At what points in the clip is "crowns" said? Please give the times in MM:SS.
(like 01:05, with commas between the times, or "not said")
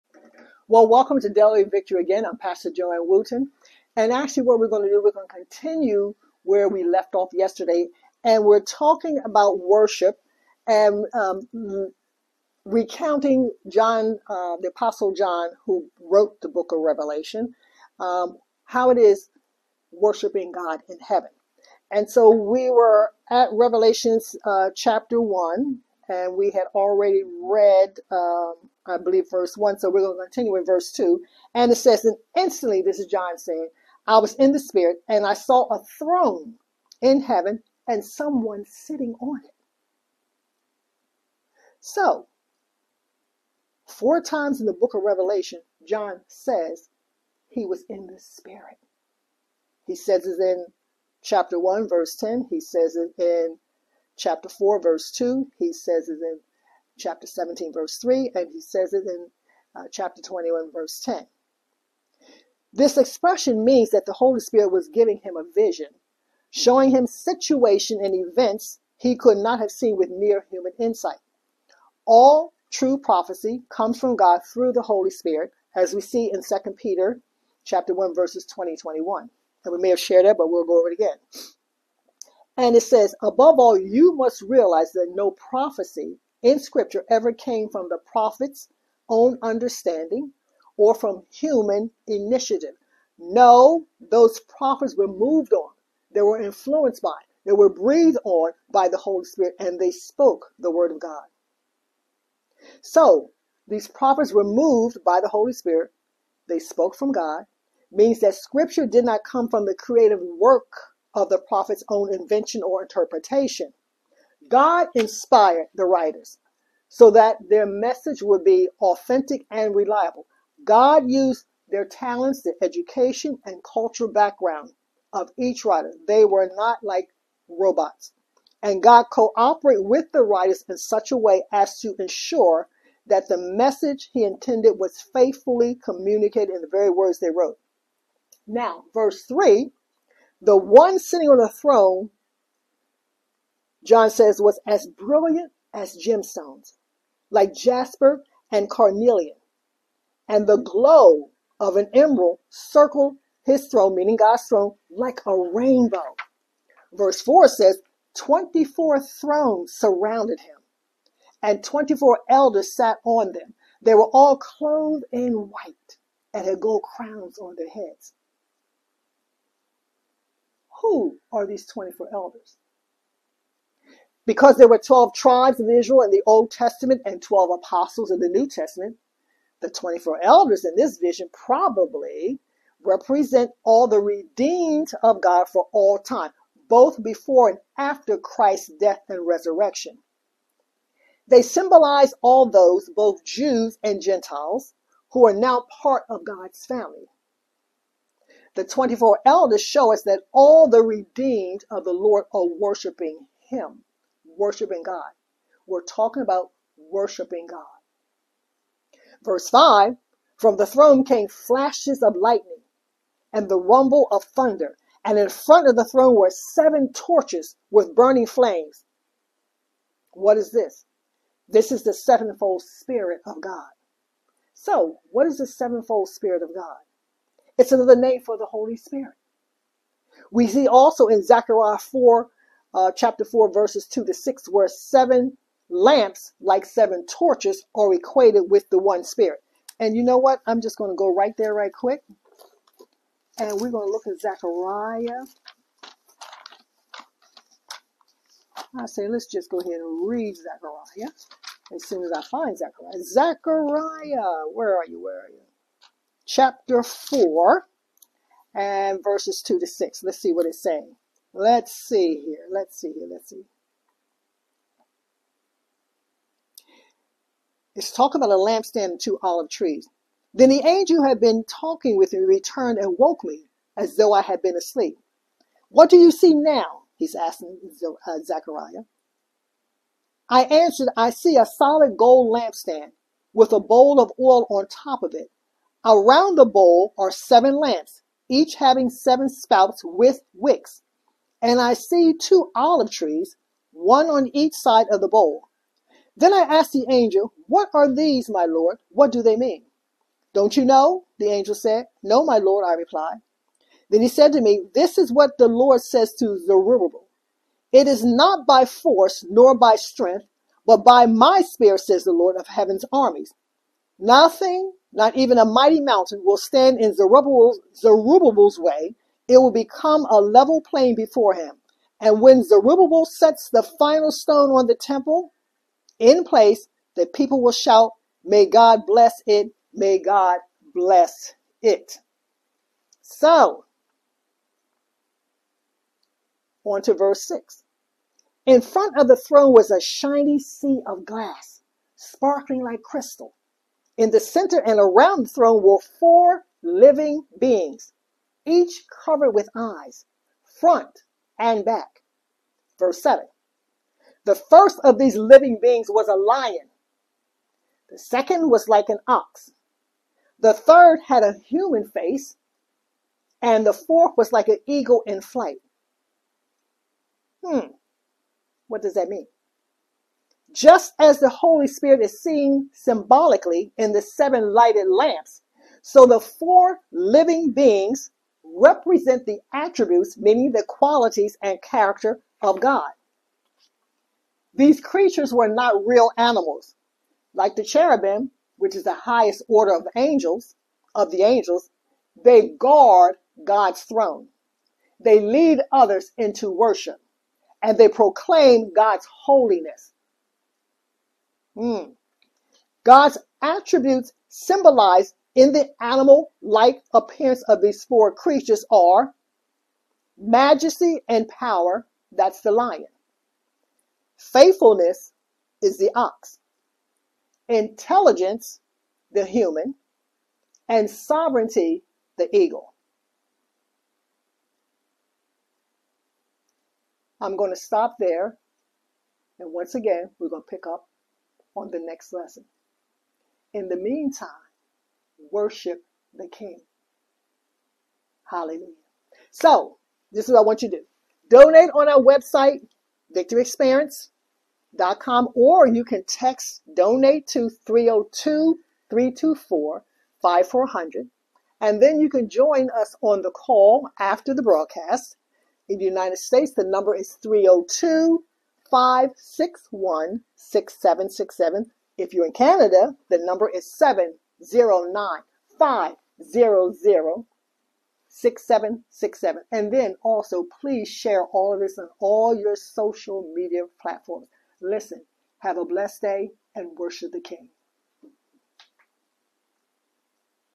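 02:46.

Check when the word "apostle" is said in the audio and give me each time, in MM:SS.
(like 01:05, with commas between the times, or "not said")
00:14, 02:57.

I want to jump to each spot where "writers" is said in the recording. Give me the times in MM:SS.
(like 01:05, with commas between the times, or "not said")
01:55, 02:05, 02:10.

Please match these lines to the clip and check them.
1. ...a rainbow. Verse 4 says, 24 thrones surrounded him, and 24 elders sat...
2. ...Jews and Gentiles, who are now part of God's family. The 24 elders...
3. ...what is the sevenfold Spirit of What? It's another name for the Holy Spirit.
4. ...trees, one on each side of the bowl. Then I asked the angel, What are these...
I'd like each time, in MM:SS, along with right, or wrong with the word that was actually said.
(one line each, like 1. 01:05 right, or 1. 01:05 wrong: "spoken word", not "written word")
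1. 02:35 right
2. 03:13 right
3. 03:45 wrong: "God", not "What"
4. 04:52 right.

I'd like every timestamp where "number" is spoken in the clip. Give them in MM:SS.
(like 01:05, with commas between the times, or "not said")
07:36, 07:43.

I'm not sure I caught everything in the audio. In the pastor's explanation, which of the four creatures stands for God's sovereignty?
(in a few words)
the eagle.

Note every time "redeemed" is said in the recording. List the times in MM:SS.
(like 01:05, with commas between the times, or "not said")
03:03, 03:20.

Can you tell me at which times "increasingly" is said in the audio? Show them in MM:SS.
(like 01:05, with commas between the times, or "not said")
not said.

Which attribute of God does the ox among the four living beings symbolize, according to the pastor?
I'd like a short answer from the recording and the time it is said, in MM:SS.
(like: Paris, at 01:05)
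Faithfulness, at 06:54.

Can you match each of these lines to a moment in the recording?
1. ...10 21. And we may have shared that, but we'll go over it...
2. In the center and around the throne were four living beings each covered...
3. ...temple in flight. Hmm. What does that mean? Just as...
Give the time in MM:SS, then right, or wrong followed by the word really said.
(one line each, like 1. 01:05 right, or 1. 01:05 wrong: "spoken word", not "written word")
1. 01:18 wrong: "20", not "10"
2. 05:43 right
3. 06:04 wrong: "eagle", not "temple".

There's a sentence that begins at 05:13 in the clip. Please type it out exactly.
Nothing, not even a mighty mountain, will stand in Zerubbabel's, Zerubbabel's way, it will become a level plain before him.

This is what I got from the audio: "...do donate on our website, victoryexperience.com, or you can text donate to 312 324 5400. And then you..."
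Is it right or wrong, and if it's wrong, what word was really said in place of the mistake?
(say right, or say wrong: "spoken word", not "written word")
wrong: "302", not "312".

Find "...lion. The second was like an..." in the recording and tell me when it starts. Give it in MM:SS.
05:56.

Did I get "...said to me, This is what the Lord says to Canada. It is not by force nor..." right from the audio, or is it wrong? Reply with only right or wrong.
wrong.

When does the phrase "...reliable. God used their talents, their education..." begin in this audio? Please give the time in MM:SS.
01:59.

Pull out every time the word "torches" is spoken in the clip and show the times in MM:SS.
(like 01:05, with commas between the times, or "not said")
03:36, 03:57.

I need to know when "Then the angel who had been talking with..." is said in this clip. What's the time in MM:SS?
04:30.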